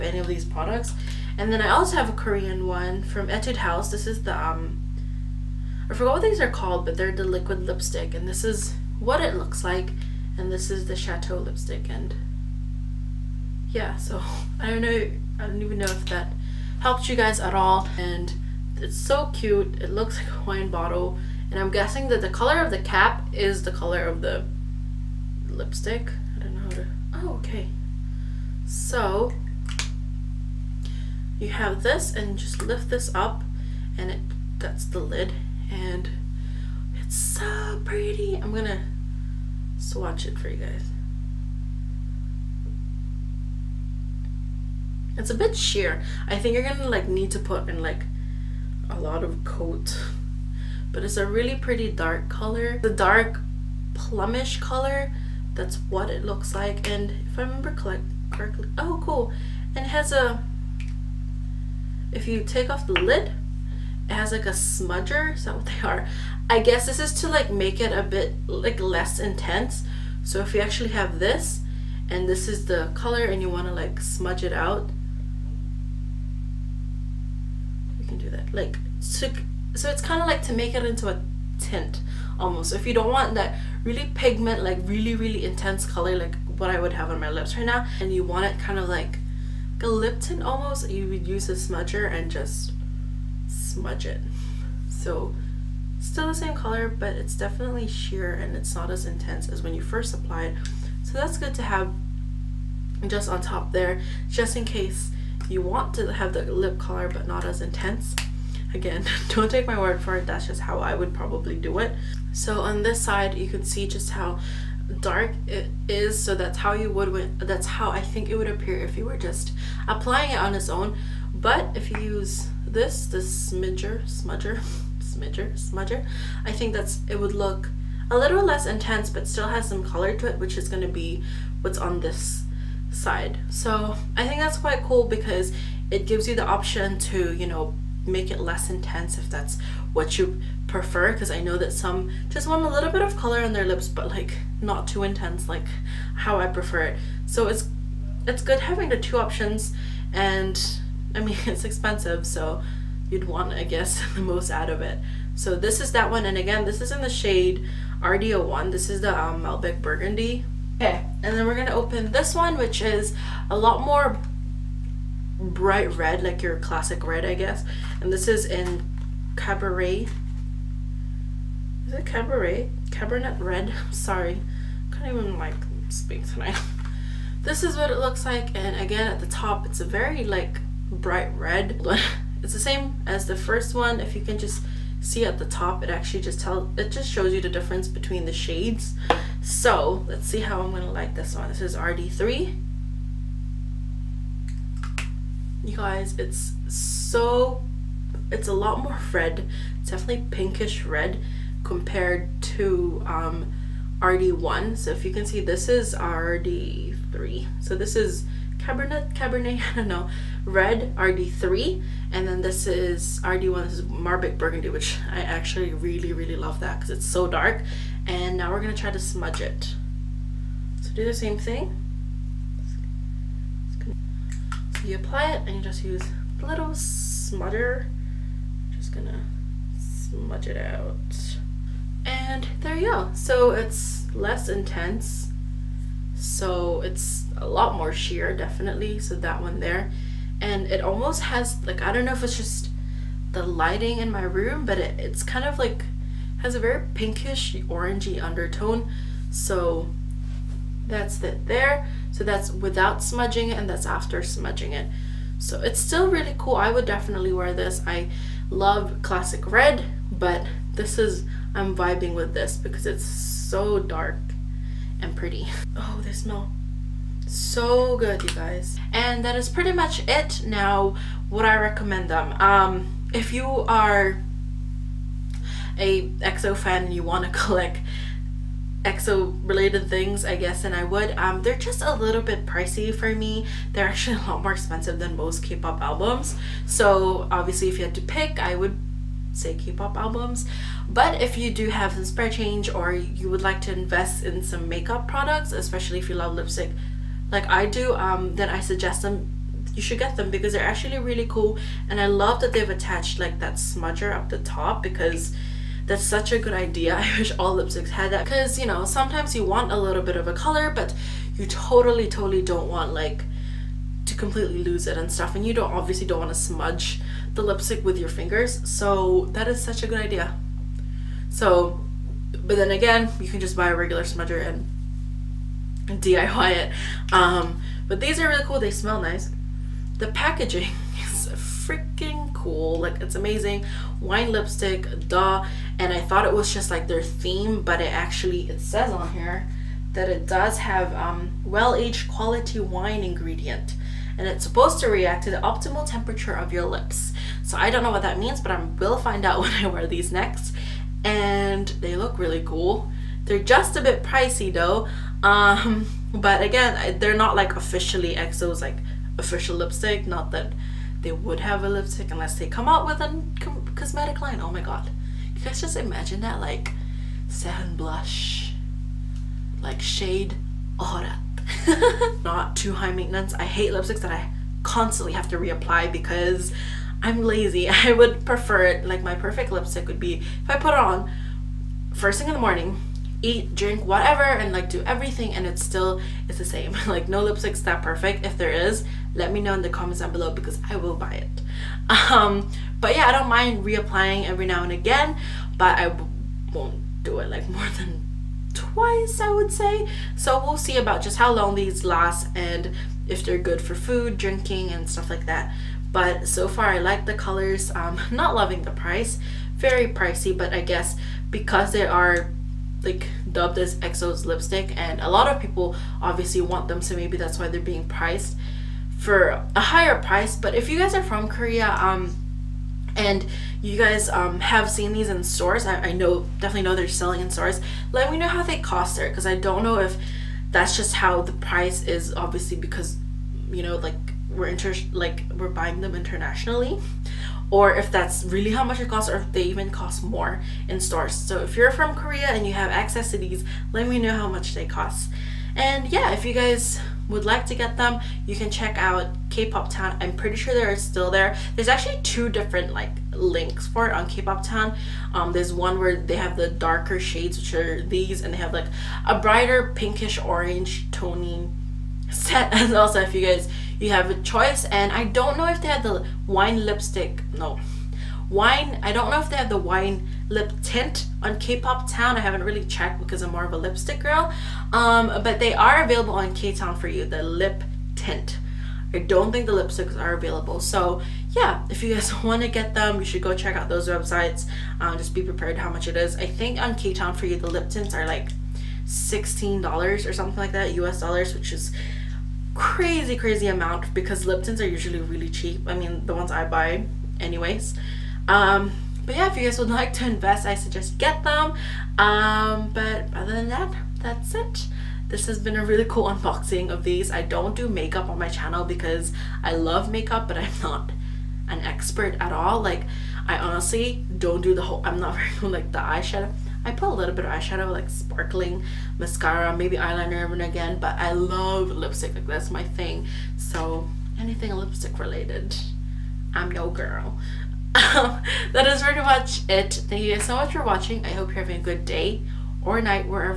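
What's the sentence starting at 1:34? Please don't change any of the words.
So still the same color, but it's definitely sheer and it's not as intense as when you first apply it.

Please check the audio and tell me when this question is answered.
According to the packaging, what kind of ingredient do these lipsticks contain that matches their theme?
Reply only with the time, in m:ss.
5:41.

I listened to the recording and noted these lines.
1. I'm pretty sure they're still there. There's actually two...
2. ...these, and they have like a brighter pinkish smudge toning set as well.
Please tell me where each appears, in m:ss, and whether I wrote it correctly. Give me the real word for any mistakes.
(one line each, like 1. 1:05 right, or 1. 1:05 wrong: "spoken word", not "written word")
1. 7:29 right
2. 7:37 wrong: "orange", not "smudge".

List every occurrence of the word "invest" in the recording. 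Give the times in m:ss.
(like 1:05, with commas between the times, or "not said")
4:53, 8:20.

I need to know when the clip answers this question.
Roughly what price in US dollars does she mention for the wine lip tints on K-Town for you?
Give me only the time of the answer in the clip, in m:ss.
8:08.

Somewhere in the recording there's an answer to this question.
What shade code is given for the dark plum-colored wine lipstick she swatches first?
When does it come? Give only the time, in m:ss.
2:38.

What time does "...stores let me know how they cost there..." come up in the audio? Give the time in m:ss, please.
7:07.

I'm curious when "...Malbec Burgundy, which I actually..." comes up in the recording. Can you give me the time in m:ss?
3:33.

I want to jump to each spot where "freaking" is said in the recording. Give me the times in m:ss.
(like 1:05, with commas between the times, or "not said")
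5:31.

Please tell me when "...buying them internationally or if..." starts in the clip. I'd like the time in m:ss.
7:15.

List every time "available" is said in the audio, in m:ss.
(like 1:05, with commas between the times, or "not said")
7:55, 8:00.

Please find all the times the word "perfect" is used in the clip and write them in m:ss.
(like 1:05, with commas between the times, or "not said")
6:19, 6:27.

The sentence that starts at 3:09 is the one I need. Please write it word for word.
So, let's see how I'm going to like this one.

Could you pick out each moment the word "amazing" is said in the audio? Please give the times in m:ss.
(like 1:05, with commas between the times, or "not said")
5:33.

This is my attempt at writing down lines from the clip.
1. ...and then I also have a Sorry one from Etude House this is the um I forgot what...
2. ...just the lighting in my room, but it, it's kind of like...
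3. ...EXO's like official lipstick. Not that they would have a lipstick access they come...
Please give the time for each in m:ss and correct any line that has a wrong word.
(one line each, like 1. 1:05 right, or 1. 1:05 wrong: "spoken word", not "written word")
1. 0:01 wrong: "Korean", not "Sorry"
2. 4:02 right
3. 5:58 wrong: "unless", not "access".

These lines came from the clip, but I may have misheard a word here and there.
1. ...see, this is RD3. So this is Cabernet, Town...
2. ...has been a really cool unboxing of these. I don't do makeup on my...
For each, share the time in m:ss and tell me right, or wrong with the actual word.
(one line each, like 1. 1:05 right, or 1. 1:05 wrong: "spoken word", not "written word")
1. 3:25 wrong: "Cabernet", not "Town"
2. 8:25 right.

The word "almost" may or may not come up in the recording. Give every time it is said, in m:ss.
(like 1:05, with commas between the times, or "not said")
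1:22, 1:30, 4:00.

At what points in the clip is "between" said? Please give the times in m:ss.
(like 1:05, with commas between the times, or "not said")
3:07.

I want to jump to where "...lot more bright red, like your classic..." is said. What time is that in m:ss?
2:43.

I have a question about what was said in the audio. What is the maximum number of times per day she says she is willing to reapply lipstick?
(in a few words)
twice.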